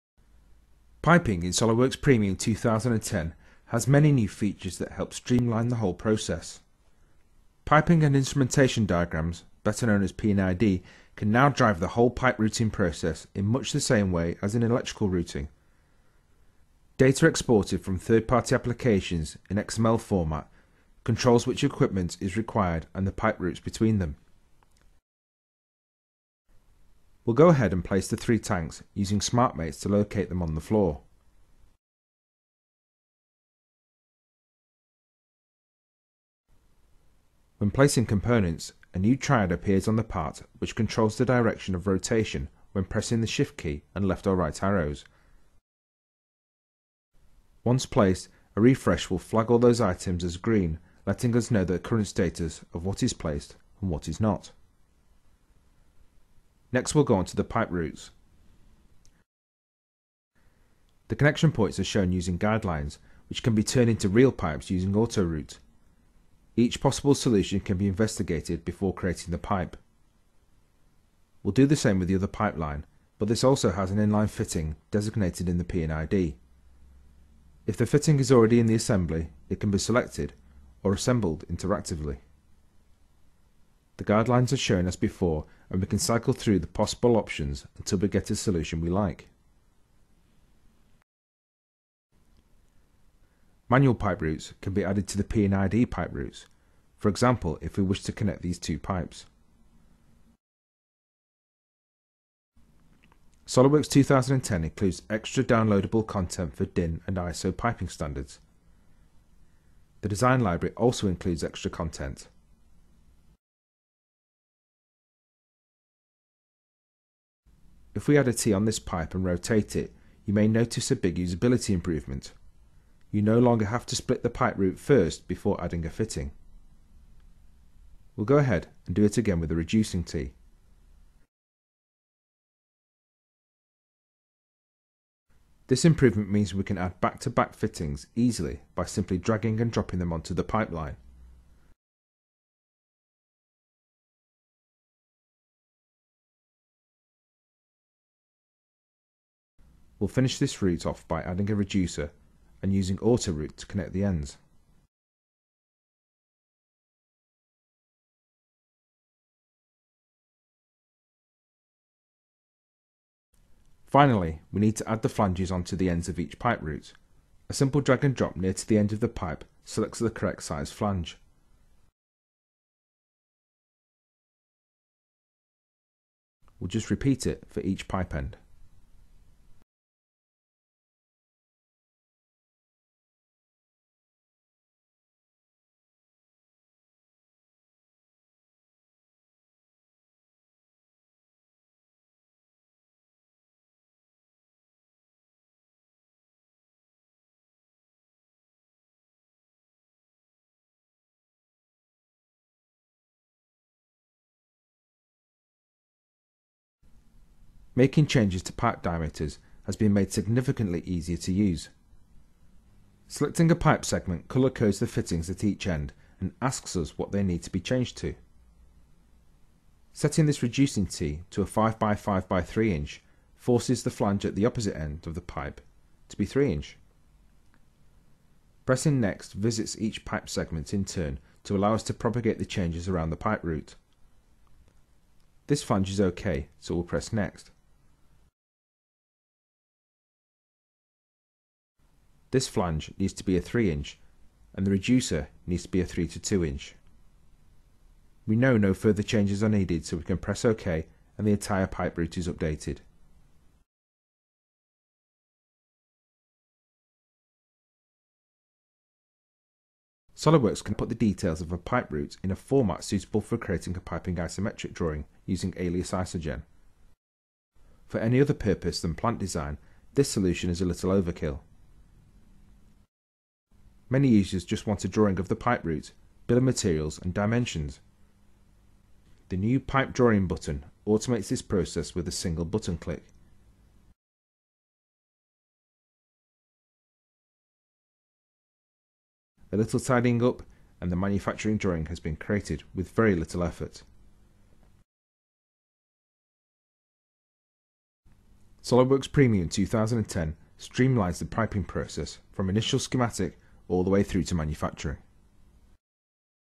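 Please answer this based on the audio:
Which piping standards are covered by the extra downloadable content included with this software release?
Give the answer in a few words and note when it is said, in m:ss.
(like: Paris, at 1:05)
DIN and ISO, at 1:46.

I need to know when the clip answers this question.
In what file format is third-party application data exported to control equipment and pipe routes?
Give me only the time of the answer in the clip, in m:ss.
0:19.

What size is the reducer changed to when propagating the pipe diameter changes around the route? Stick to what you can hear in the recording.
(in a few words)
3 to 2 inch.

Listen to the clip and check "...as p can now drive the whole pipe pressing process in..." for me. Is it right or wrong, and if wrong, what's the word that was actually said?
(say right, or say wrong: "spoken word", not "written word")
wrong: "routing", not "pressing".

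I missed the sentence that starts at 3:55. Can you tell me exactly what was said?
This flange is OK, so we'll press next.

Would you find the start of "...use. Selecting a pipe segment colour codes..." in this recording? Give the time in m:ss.
3:31.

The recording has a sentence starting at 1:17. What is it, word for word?
If the fitting is already in the assembly, it can be selected or assembled interactively.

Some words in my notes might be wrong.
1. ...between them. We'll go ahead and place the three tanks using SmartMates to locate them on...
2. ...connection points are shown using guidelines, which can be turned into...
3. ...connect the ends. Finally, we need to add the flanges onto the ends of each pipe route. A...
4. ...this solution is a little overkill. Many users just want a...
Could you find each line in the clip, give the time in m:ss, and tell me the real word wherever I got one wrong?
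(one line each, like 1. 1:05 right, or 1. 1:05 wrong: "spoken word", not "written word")
1. 0:23 right
2. 1:01 right
3. 2:33 right
4. 4:29 right.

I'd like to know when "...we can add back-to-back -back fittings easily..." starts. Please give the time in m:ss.
2:16.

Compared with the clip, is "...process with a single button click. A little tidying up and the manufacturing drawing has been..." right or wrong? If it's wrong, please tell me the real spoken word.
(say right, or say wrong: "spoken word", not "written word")
right.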